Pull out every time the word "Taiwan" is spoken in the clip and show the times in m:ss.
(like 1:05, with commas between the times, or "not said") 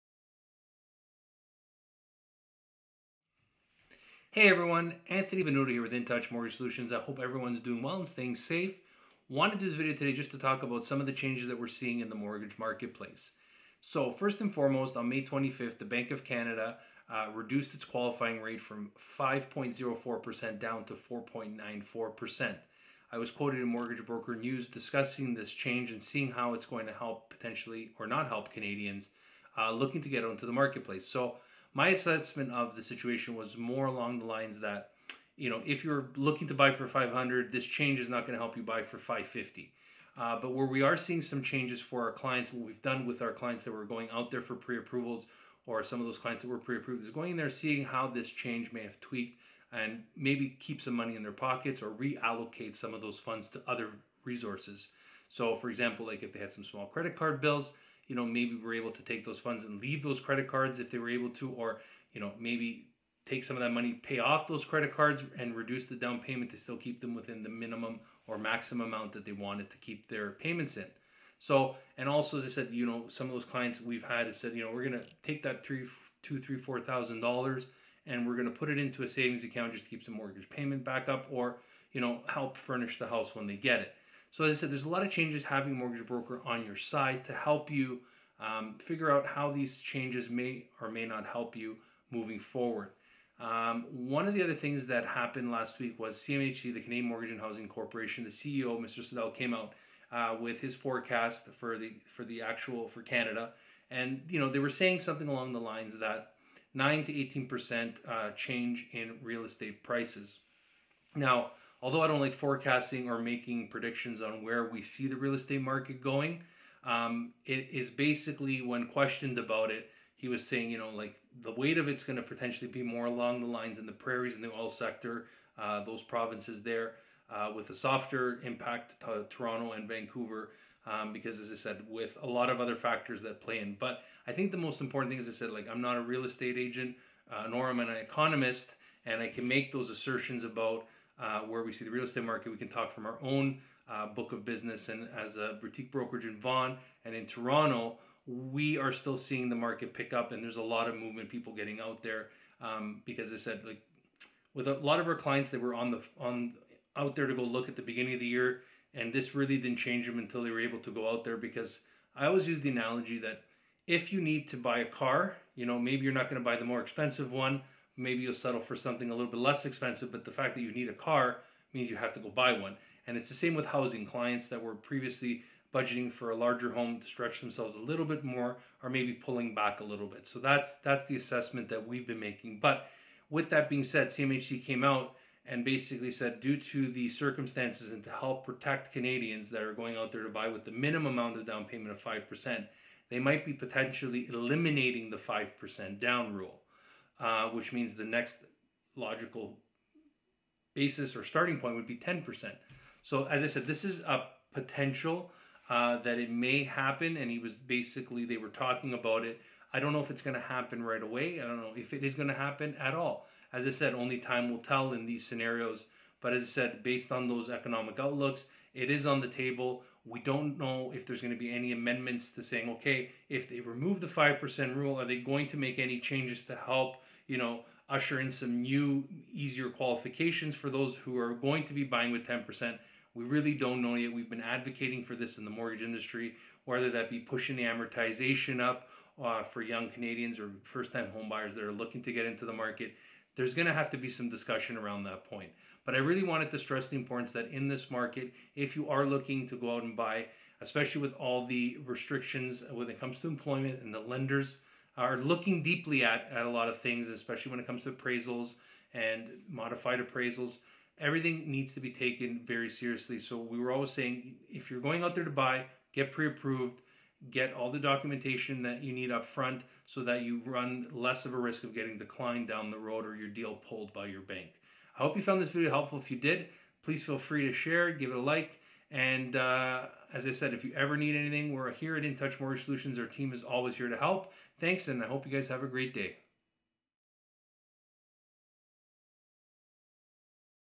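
not said.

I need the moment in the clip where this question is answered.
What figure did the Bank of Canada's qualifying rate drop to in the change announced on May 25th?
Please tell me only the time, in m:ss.
0:20.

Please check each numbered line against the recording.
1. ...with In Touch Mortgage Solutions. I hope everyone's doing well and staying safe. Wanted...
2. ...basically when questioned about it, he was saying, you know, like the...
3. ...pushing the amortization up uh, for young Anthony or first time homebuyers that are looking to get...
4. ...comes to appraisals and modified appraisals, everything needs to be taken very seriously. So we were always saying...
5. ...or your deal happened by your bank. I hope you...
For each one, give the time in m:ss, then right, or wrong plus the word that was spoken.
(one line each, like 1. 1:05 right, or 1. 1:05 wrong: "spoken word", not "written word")
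1. 0:05 right
2. 1:57 right
3. 3:57 wrong: "Canadians", not "Anthony"
4. 4:17 right
5. 4:33 wrong: "pulled", not "happened".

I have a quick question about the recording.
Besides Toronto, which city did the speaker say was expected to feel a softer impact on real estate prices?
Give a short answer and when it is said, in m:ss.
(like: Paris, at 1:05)
Vancouver, at 2:09.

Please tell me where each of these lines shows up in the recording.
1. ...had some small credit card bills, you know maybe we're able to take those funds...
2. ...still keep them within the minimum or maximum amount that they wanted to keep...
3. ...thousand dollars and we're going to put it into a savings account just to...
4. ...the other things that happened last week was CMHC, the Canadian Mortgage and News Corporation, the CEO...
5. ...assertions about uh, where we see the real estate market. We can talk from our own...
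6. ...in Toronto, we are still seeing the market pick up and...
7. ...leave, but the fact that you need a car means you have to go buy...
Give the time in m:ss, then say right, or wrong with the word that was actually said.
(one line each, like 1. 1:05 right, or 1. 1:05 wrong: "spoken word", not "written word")
1. 0:56 right
2. 1:06 right
3. 1:16 right
4. 1:34 wrong: "Housing", not "News"
5. 2:19 right
6. 2:27 right
7. 2:49 wrong: "expensive", not "leave".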